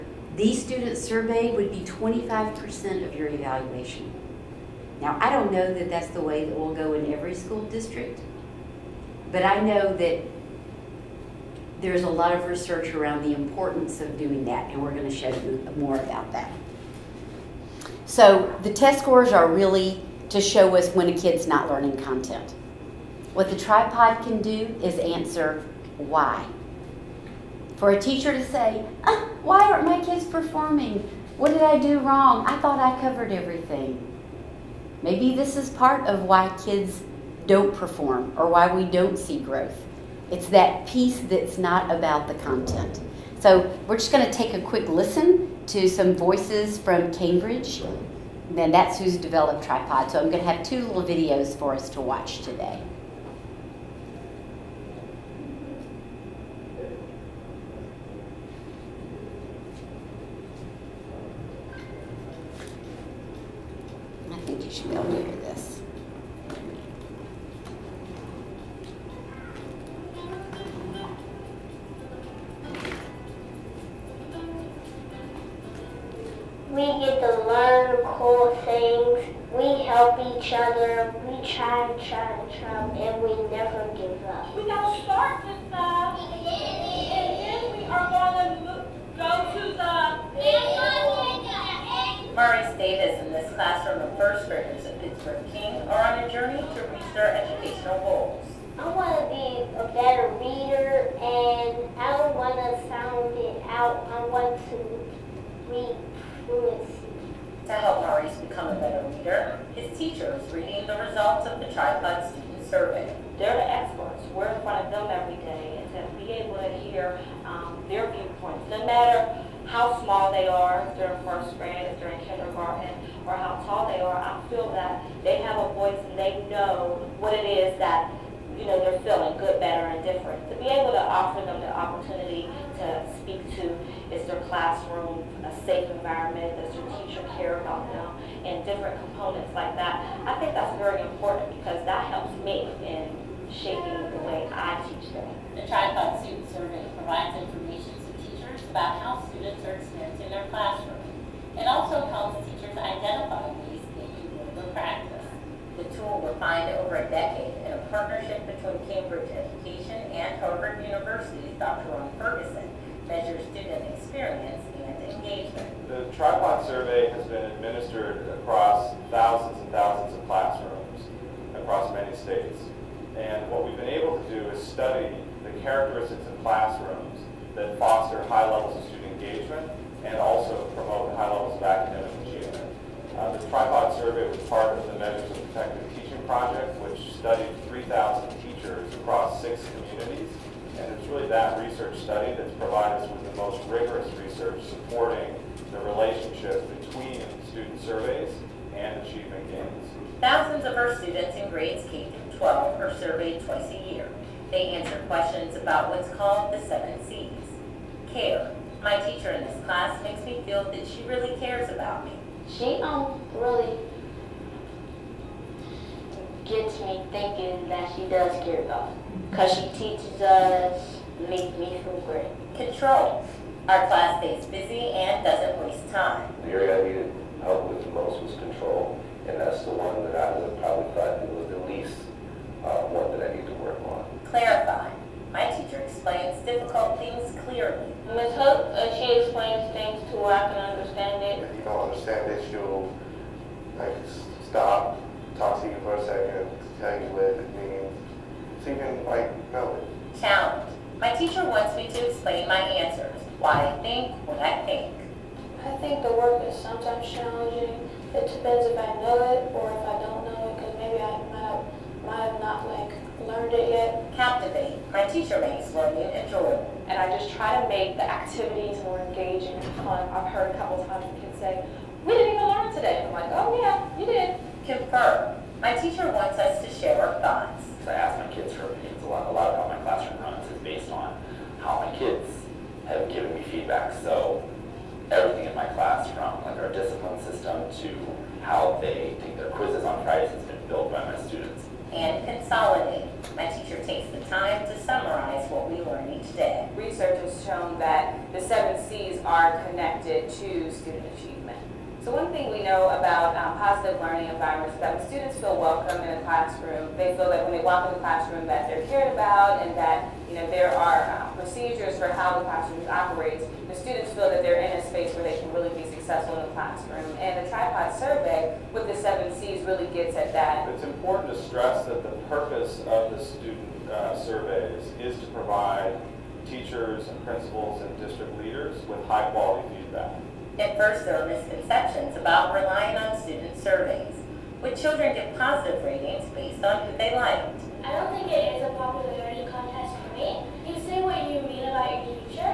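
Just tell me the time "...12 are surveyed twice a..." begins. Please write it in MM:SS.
03:22.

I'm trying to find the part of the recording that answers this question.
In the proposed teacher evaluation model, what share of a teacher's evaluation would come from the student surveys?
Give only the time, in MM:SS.
00:01.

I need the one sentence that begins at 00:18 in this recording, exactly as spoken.
So the test scores are really to show us when a kid's not learning content.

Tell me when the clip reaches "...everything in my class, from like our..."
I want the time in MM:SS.
04:45.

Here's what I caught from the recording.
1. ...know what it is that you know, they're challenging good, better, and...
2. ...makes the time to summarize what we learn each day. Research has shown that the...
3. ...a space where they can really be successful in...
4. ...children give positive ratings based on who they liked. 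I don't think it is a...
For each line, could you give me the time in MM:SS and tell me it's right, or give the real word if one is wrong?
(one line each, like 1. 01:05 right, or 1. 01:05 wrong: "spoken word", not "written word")
1. 02:06 wrong: "feeling", not "challenging"
2. 04:53 wrong: "takes", not "makes"
3. 05:14 right
4. 05:34 right.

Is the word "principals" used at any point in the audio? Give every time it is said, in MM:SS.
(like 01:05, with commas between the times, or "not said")
05:27.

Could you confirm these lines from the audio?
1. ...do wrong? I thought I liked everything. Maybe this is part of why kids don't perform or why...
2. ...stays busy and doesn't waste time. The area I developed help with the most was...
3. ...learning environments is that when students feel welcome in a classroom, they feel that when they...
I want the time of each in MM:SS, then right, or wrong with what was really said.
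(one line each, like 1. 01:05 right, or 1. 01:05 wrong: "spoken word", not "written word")
1. 00:31 wrong: "covered", not "liked"
2. 03:44 wrong: "needed", not "developed"
3. 05:04 right.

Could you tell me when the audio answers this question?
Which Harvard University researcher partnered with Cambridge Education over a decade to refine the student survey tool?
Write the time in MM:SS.
02:41.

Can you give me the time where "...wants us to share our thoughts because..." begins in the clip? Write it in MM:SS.
04:36.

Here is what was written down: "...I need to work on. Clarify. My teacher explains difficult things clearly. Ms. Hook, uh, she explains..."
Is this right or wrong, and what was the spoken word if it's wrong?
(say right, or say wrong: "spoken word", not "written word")
right.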